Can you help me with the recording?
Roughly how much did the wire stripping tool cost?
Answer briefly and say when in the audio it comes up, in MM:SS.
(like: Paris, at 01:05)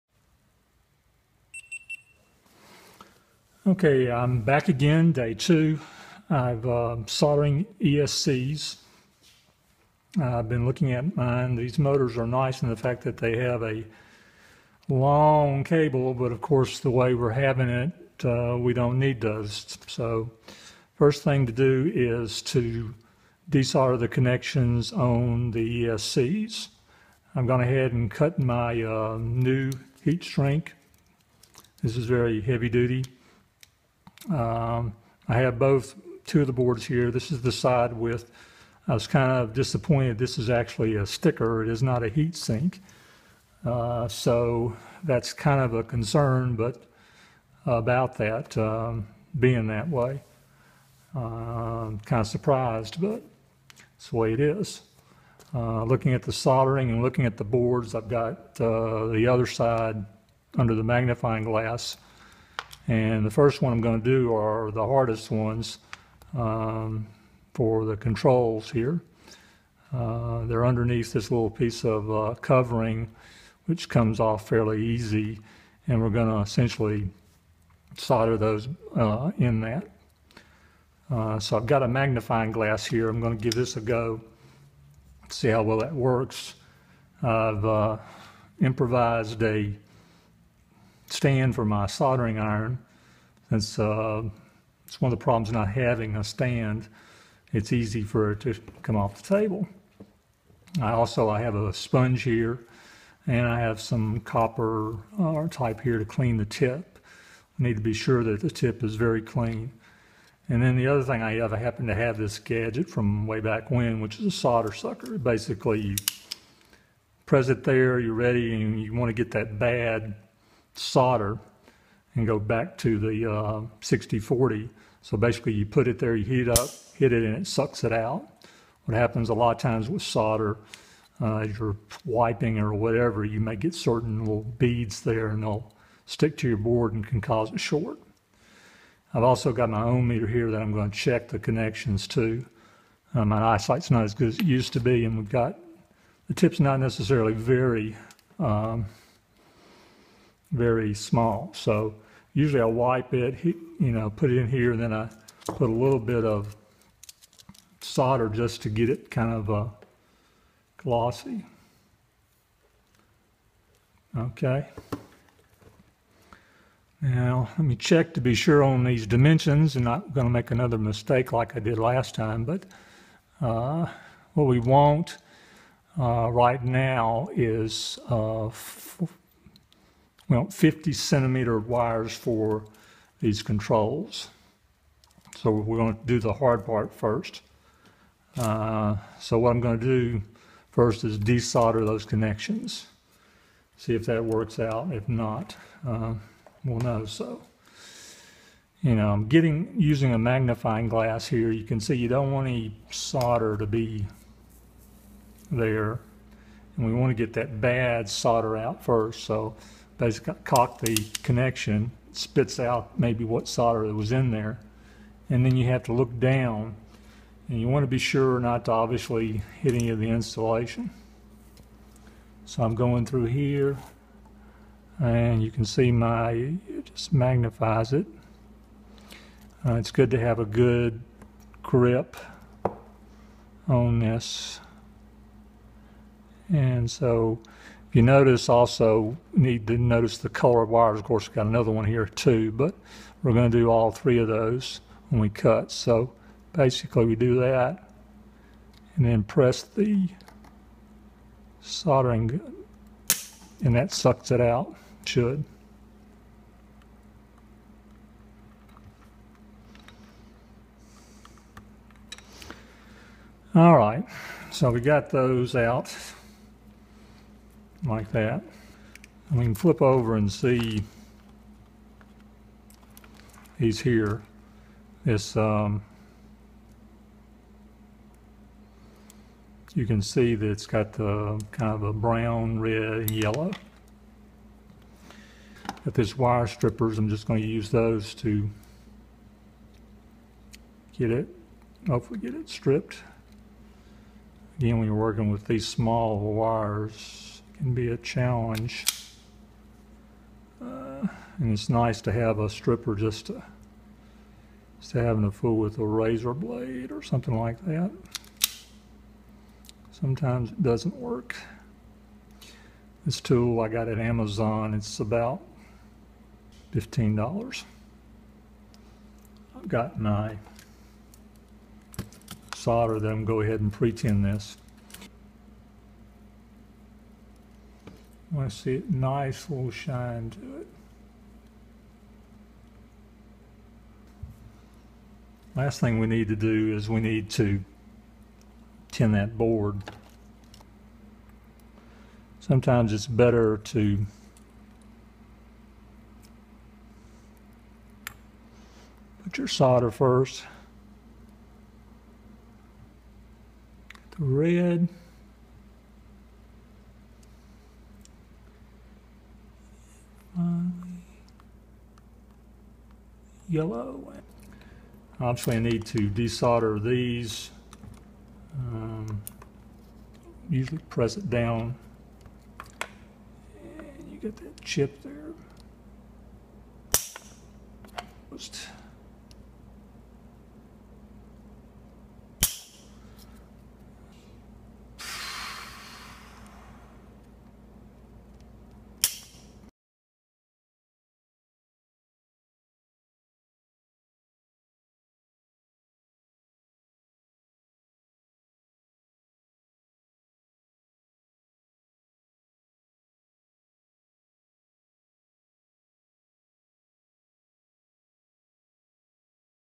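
$15, at 05:16.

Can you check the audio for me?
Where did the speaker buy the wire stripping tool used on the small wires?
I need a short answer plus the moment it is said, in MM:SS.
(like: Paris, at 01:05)
Amazon, at 05:13.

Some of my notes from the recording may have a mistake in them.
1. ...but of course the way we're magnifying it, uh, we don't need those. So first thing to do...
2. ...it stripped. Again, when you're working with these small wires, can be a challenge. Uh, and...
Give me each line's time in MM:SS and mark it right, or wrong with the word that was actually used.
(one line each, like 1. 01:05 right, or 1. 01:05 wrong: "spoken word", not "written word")
1. 00:16 wrong: "having", not "magnifying"
2. 04:52 right.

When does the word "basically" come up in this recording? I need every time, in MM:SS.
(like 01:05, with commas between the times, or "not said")
01:55, 02:05, 03:30, 04:06.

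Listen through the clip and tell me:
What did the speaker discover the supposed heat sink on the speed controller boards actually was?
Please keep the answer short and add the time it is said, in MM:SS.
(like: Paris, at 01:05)
a sticker, at 00:40.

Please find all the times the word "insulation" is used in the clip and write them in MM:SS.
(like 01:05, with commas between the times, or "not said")
03:40.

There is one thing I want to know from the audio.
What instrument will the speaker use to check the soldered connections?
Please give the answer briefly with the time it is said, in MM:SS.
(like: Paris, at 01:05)
ohm meter, at 02:19.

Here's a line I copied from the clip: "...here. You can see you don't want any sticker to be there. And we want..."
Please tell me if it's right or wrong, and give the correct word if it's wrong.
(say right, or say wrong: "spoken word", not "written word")
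wrong: "solder", not "sticker".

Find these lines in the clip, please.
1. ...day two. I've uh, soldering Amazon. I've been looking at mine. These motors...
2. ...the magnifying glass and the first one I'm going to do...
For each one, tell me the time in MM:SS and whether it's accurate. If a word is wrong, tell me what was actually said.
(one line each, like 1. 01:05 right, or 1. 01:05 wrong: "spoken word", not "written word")
1. 00:05 wrong: "ESCs", not "Amazon"
2. 01:00 right.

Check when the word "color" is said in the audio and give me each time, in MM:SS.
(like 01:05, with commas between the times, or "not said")
04:00.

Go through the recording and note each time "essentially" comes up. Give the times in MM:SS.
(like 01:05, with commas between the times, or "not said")
01:16.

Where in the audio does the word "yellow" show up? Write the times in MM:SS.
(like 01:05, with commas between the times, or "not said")
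04:43, 06:03.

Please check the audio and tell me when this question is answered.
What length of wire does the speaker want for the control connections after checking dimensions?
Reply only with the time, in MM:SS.
03:00.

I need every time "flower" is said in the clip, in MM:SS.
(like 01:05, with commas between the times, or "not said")
not said.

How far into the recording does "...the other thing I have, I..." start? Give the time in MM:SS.
01:50.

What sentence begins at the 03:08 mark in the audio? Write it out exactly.
Uh, so what I'm going to do first is desolder those connections.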